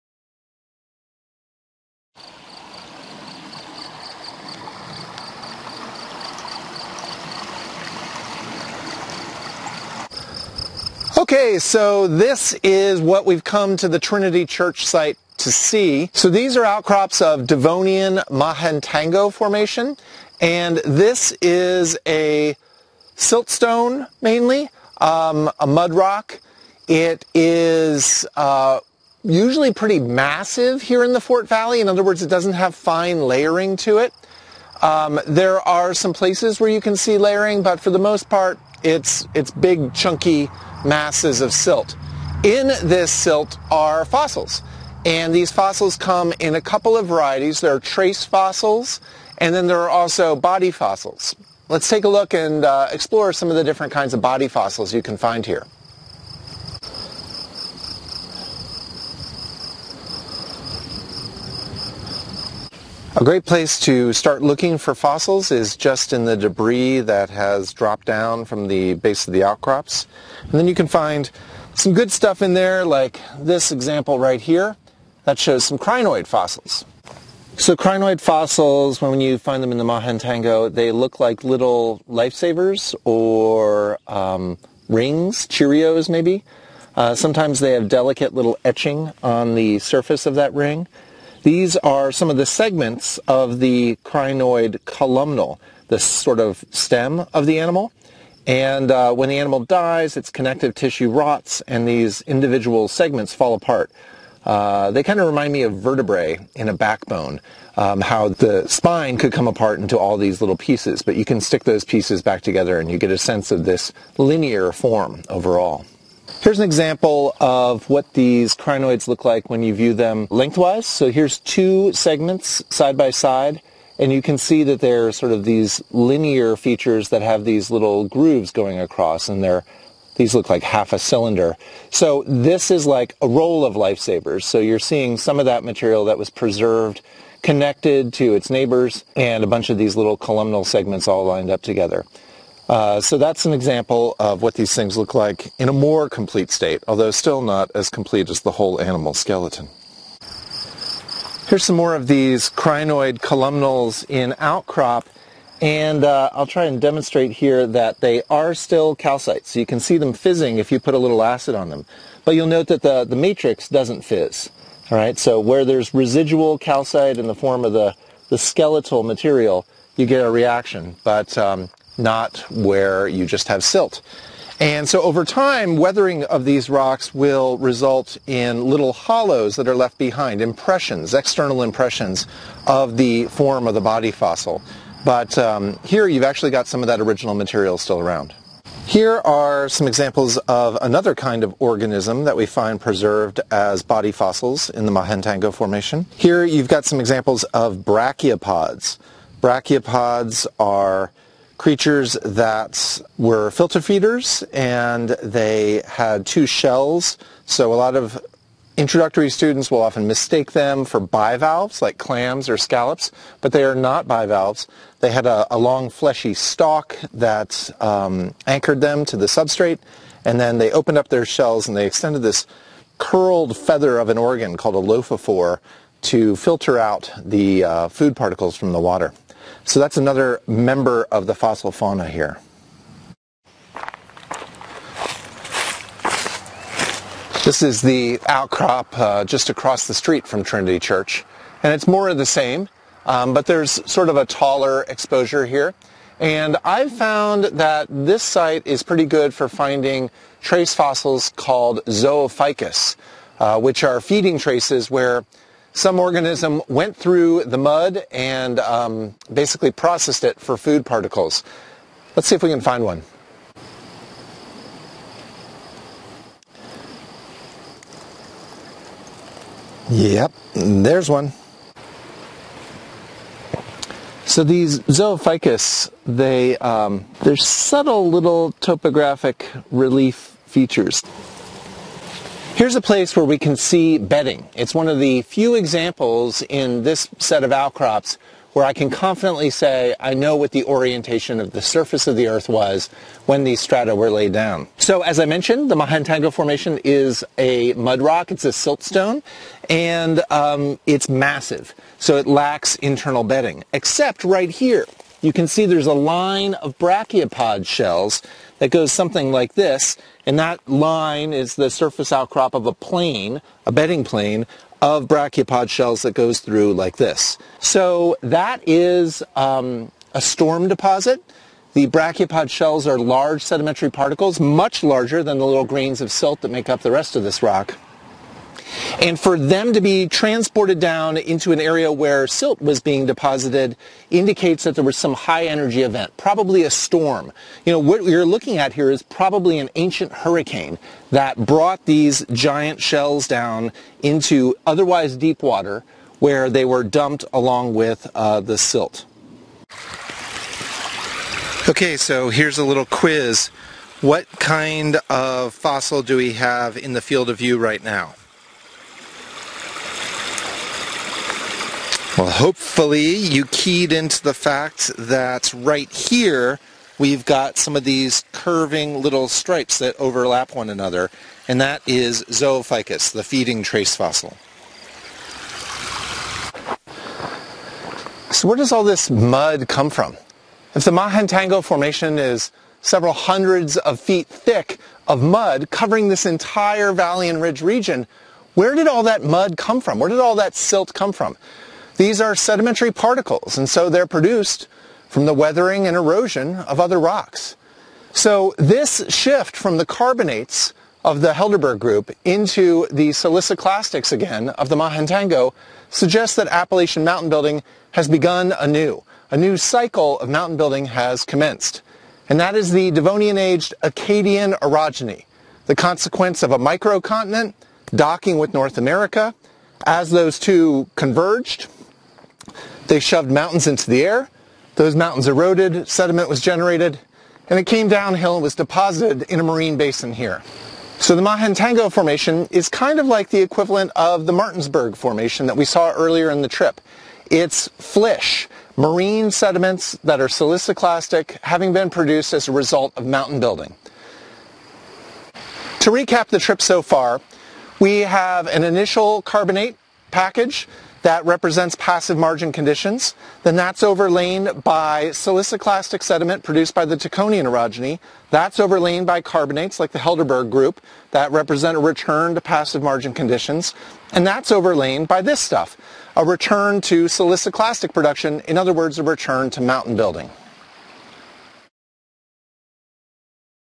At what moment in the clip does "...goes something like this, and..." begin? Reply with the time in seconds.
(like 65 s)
308 s.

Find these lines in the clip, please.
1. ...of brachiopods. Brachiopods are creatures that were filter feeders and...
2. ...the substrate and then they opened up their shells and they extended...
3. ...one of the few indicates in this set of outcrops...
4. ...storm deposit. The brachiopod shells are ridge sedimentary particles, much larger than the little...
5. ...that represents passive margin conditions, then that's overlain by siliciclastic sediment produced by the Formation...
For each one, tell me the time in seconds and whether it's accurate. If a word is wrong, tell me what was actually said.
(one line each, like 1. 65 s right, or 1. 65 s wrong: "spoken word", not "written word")
1. 197 s right
2. 219 s right
3. 284 s wrong: "examples", not "indicates"
4. 320 s wrong: "large", not "ridge"
5. 451 s wrong: "Taconian", not "Formation".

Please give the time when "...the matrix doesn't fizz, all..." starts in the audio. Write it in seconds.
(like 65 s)
163 s.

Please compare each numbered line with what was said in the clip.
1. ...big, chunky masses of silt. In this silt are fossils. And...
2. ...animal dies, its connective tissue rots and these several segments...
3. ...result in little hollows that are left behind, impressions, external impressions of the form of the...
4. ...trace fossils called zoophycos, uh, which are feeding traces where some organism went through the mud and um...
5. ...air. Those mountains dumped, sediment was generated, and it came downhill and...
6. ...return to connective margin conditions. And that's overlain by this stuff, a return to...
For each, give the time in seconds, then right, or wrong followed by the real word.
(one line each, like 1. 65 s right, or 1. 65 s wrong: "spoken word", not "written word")
1. 39 s right
2. 99 s wrong: "individual", not "several"
3. 177 s right
4. 250 s right
5. 424 s wrong: "eroded", not "dumped"
6. 461 s wrong: "passive", not "connective".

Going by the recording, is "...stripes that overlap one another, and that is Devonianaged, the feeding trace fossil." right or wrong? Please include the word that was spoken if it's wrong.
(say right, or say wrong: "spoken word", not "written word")
wrong: "Zoophycos", not "Devonianaged".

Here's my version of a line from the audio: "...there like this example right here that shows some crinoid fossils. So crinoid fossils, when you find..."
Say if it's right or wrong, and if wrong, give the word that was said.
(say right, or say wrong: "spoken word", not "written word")
right.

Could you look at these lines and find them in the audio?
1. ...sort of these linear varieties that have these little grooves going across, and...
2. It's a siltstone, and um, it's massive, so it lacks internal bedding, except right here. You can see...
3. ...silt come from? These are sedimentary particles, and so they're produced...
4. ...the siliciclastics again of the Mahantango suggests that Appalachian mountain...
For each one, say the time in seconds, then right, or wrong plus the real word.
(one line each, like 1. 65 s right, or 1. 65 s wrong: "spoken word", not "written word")
1. 125 s wrong: "features", not "varieties"
2. 298 s right
3. 390 s right
4. 402 s right.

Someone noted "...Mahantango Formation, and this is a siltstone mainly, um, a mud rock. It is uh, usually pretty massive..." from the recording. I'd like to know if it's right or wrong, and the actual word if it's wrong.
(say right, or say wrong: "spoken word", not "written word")
right.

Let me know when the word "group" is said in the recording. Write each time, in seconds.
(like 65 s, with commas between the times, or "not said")
401 s, 460 s.